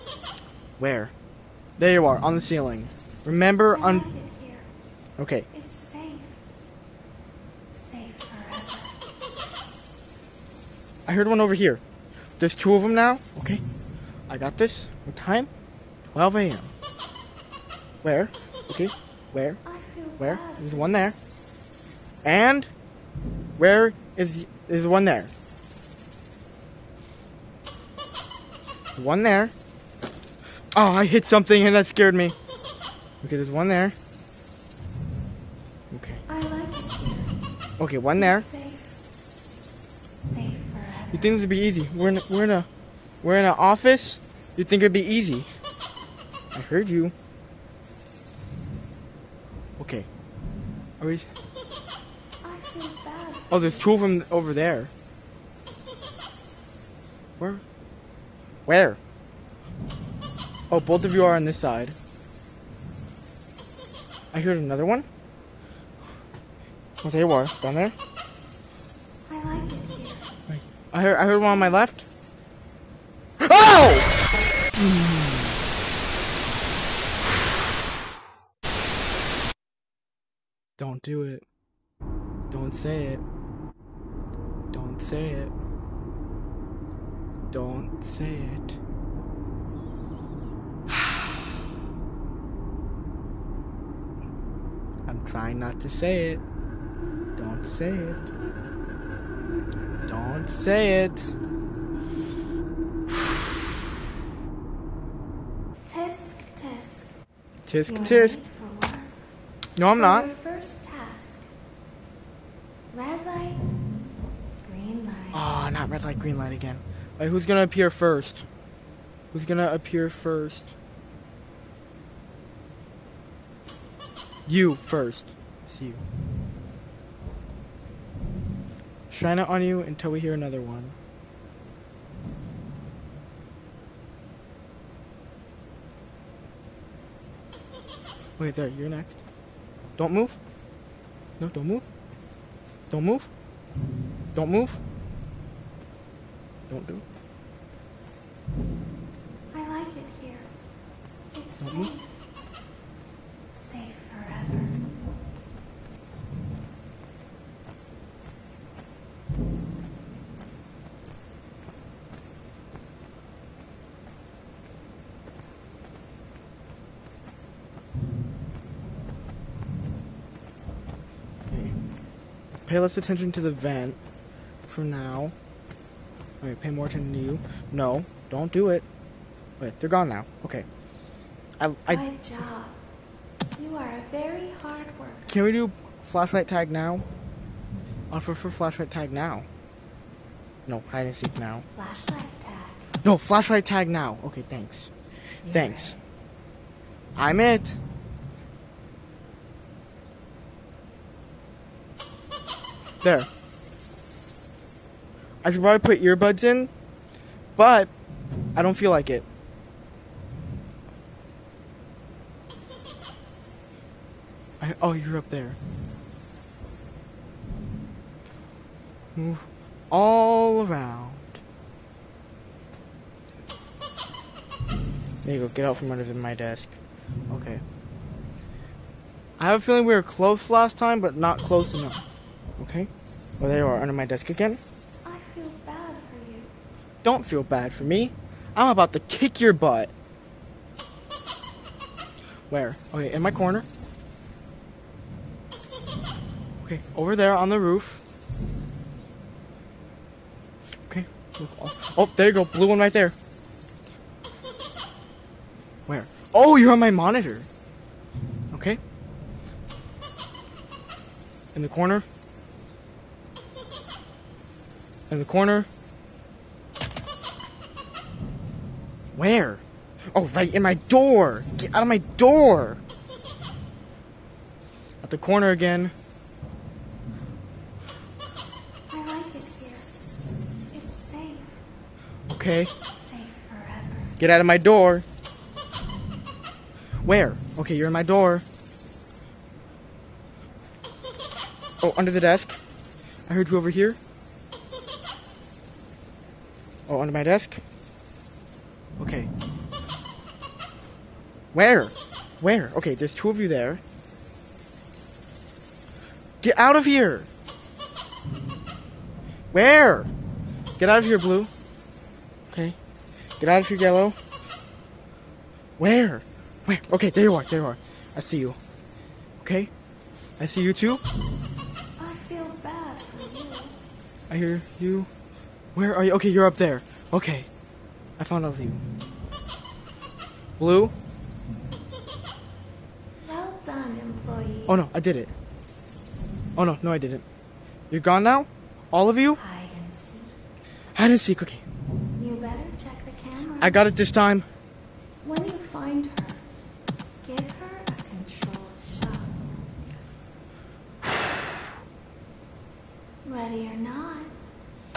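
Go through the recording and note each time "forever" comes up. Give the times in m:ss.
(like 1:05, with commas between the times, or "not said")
0:08, 4:43.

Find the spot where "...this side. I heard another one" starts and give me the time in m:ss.
1:01.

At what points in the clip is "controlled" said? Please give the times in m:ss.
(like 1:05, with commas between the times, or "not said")
5:48.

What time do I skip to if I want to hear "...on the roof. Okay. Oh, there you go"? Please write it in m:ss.
4:07.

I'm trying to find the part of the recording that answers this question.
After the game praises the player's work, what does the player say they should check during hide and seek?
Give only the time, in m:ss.
5:42.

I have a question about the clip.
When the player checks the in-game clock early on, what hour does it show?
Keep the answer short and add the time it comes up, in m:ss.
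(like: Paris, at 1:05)
12 a.m., at 0:16.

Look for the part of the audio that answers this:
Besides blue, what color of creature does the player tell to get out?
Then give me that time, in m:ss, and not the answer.
5:13.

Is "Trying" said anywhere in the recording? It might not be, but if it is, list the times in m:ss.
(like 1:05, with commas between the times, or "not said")
1:35.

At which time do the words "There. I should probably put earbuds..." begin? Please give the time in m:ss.
3:23.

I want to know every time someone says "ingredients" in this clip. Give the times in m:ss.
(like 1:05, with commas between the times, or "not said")
not said.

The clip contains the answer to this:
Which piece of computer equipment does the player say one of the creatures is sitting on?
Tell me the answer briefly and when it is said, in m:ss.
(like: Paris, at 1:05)
Monitor, at 4:16.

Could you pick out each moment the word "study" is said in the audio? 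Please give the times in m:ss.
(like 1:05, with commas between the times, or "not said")
not said.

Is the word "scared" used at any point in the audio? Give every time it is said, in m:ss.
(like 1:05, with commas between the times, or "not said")
0:31.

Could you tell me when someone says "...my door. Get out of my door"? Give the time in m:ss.
4:30.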